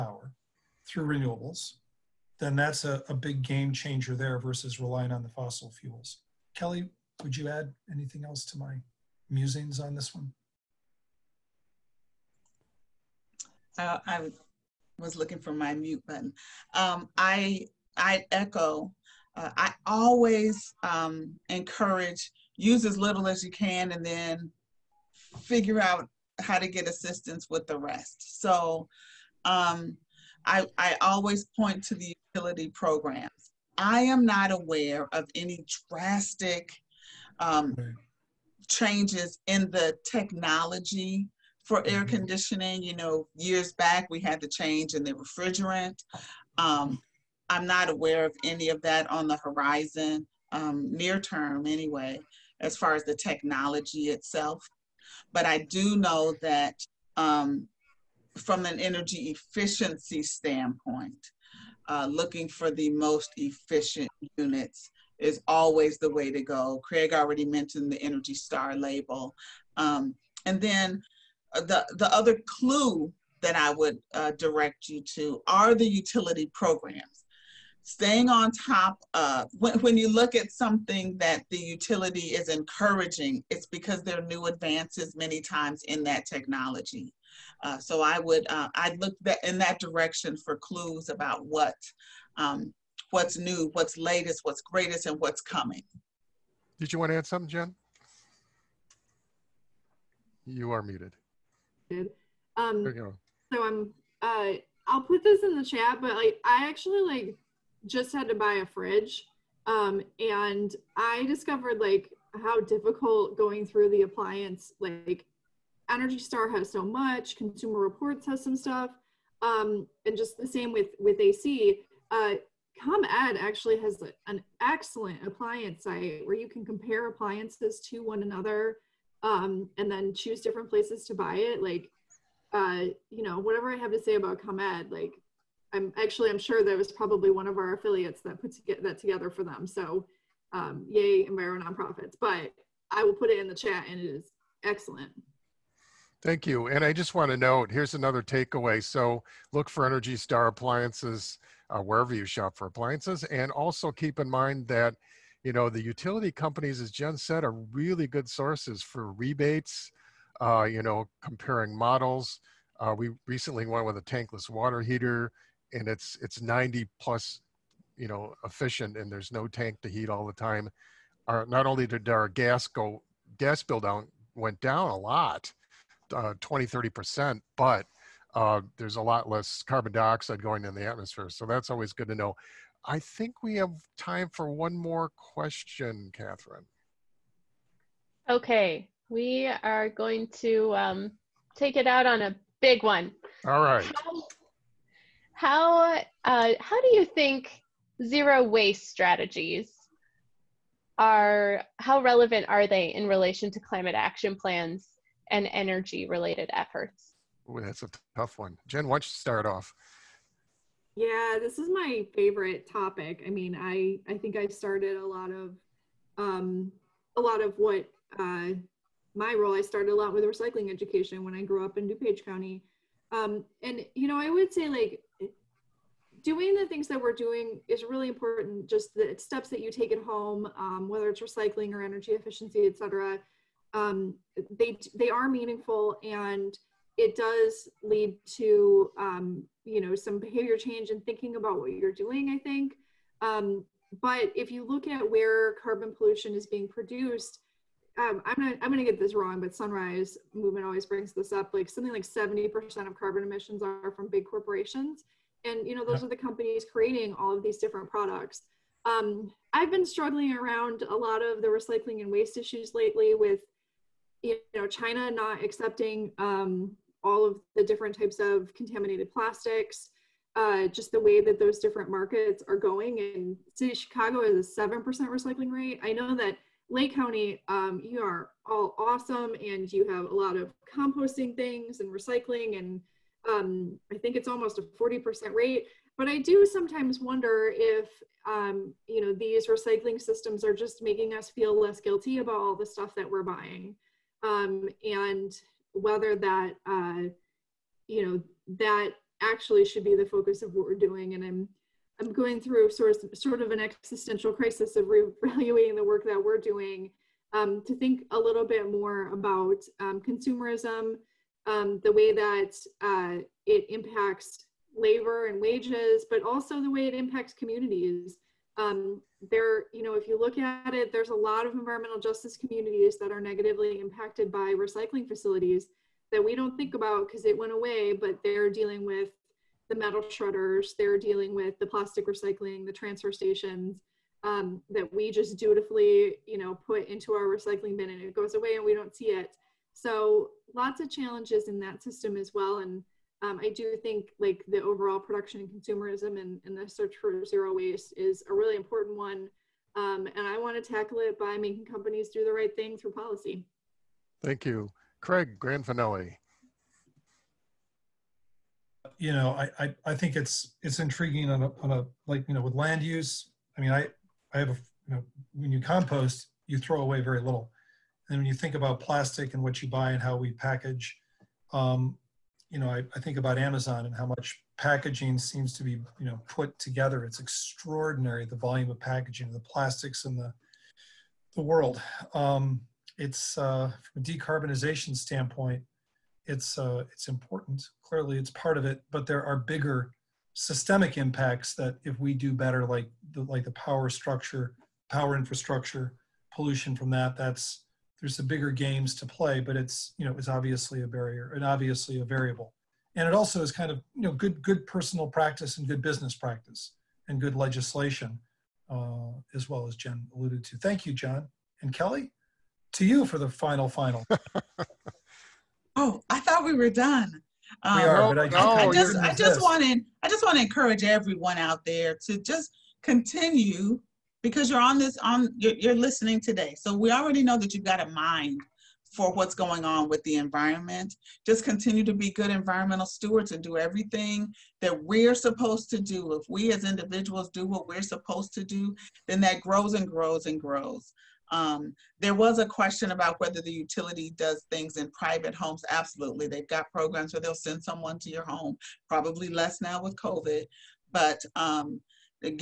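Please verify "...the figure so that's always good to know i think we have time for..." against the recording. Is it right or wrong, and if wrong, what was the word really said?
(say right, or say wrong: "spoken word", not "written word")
wrong: "atmosphere", not "figure".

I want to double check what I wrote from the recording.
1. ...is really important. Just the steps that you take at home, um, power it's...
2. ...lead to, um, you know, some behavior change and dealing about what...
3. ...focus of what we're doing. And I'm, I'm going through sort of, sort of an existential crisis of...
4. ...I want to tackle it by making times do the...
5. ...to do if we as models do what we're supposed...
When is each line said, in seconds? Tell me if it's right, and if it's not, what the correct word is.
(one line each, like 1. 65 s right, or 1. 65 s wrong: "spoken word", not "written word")
1. 227 s wrong: "whether", not "power"
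2. 237 s wrong: "thinking", not "dealing"
3. 300 s right
4. 350 s wrong: "companies", not "times"
5. 435 s wrong: "individuals", not "models".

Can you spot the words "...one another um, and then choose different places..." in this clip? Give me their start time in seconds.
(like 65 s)
128 s.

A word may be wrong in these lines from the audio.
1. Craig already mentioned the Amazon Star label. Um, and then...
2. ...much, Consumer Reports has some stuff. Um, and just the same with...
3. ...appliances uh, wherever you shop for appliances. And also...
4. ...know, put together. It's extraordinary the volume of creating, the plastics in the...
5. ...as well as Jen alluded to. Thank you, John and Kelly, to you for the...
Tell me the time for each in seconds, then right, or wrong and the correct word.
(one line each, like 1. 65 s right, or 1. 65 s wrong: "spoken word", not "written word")
1. 66 s wrong: "Energy", not "Amazon"
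2. 116 s right
3. 150 s right
4. 376 s wrong: "packaging", not "creating"
5. 409 s right.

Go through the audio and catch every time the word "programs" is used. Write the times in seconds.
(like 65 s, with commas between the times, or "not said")
32 s, 76 s, 446 s.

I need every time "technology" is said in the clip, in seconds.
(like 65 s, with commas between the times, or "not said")
40 s, 53 s, 86 s.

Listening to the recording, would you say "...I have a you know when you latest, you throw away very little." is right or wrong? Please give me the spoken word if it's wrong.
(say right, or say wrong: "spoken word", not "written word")
wrong: "compost", not "latest".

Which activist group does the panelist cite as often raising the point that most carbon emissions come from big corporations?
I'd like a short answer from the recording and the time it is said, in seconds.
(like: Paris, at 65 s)
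Sunrise Movement, at 249 s.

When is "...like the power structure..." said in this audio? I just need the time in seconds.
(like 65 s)
393 s.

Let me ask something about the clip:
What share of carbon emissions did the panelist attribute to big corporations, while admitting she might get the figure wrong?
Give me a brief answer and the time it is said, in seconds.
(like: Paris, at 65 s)
70%, at 252 s.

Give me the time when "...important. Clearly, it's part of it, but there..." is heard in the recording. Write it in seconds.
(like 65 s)
387 s.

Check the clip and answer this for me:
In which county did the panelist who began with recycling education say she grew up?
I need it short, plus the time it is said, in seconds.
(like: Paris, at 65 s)
DuPage County, at 221 s.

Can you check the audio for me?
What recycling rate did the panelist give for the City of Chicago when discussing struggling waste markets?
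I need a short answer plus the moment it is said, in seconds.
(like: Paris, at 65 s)
7%, at 274 s.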